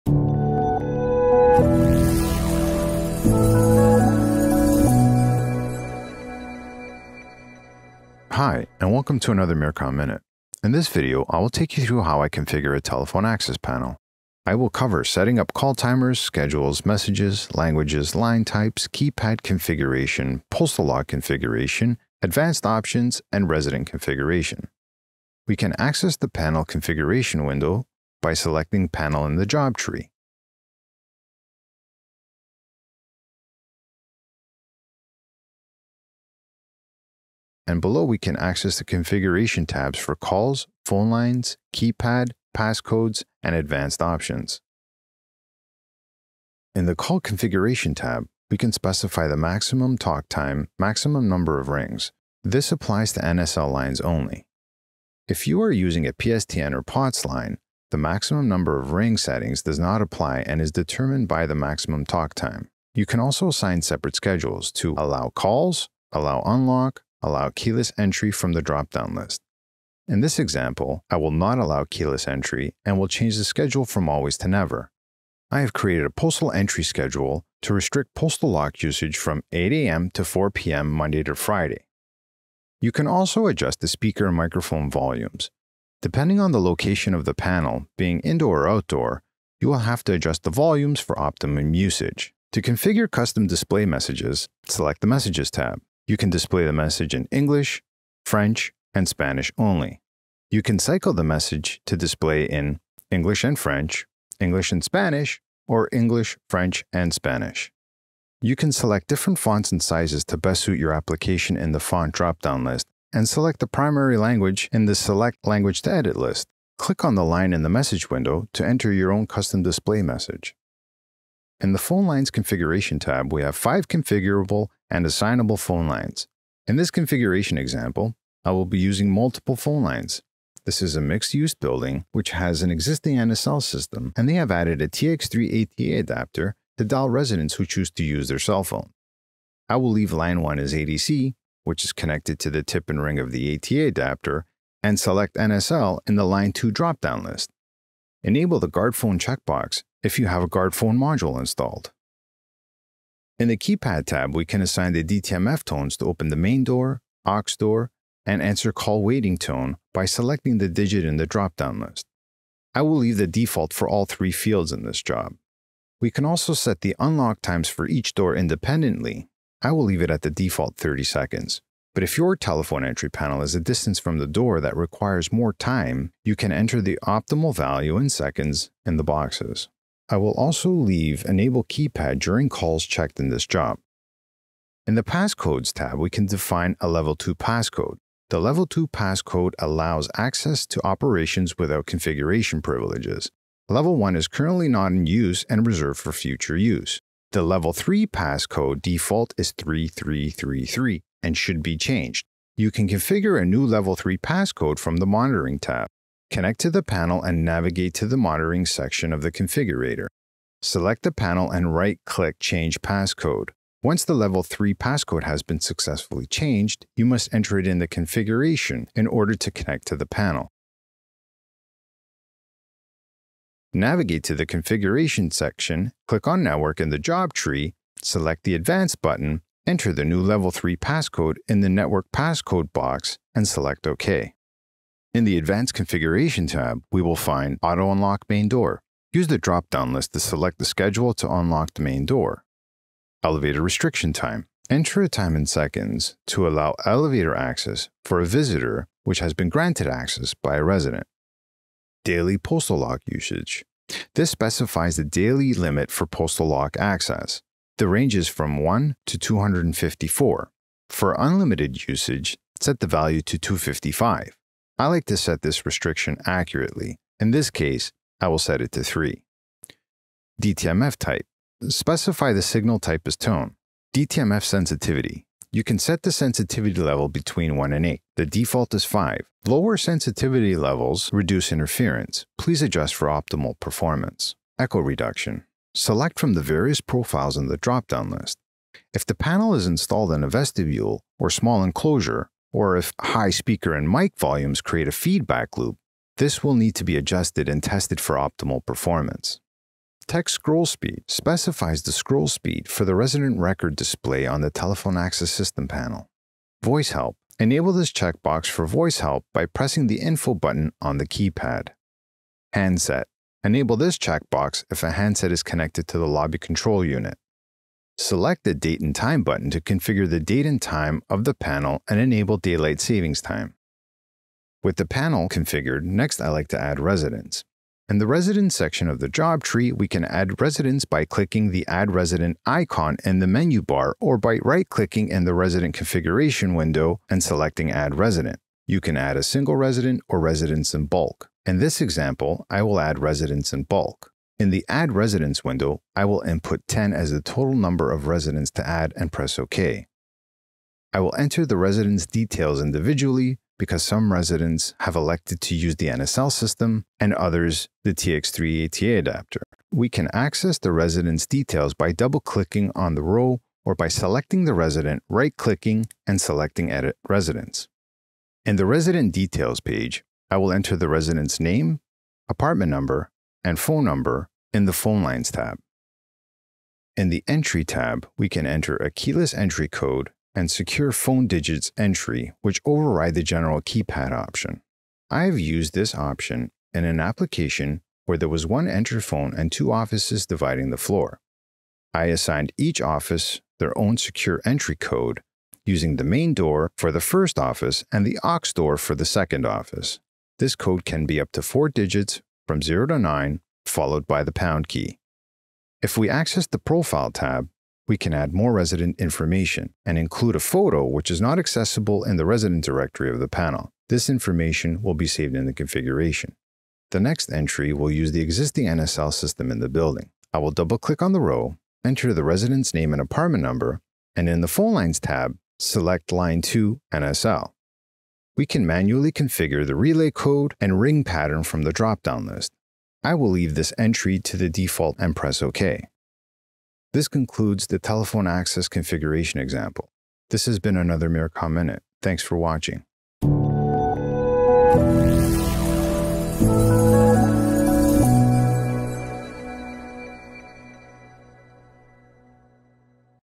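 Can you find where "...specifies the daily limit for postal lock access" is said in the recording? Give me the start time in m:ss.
4:14.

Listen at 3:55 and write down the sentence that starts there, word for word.
In the Advanced Configuration tab, we will find Auto Unlock Main Door.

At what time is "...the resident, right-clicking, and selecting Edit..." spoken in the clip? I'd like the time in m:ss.
6:04.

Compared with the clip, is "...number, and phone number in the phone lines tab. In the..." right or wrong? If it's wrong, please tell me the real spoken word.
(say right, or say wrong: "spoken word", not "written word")
right.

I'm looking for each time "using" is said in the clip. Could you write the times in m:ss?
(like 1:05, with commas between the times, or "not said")
0:55, 2:08, 6:35.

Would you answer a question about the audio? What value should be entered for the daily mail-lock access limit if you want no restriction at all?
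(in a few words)
255.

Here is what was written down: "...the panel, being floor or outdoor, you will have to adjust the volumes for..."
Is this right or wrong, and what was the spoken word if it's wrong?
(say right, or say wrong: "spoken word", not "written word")
wrong: "indoor", not "floor".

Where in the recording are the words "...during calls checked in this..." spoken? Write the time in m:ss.
3:02.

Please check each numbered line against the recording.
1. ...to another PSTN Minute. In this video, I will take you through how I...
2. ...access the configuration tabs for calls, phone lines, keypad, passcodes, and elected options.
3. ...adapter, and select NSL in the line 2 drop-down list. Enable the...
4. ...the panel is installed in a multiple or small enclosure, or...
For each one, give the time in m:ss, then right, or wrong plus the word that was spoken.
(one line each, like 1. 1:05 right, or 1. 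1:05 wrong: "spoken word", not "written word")
1. 0:09 wrong: "Mircom", not "PSTN"
2. 0:38 wrong: "advanced", not "elected"
3. 2:23 right
4. 4:49 wrong: "vestibule", not "multiple".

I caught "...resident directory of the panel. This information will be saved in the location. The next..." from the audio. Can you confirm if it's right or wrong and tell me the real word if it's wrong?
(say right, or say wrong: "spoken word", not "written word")
wrong: "configuration", not "location".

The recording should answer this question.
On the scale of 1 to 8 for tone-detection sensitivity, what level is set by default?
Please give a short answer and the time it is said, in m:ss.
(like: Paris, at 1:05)
5, at 4:38.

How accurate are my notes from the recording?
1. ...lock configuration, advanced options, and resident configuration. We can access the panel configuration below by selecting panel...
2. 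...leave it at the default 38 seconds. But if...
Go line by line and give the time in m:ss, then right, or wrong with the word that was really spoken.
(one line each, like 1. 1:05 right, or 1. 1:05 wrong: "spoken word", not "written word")
1. 0:20 wrong: "window", not "below"
2. 2:49 wrong: "30", not "38".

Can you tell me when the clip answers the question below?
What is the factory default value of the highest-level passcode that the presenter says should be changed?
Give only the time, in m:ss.
3:19.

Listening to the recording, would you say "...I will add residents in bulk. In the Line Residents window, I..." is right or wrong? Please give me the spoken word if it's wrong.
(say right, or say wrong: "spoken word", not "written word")
wrong: "Add", not "Line".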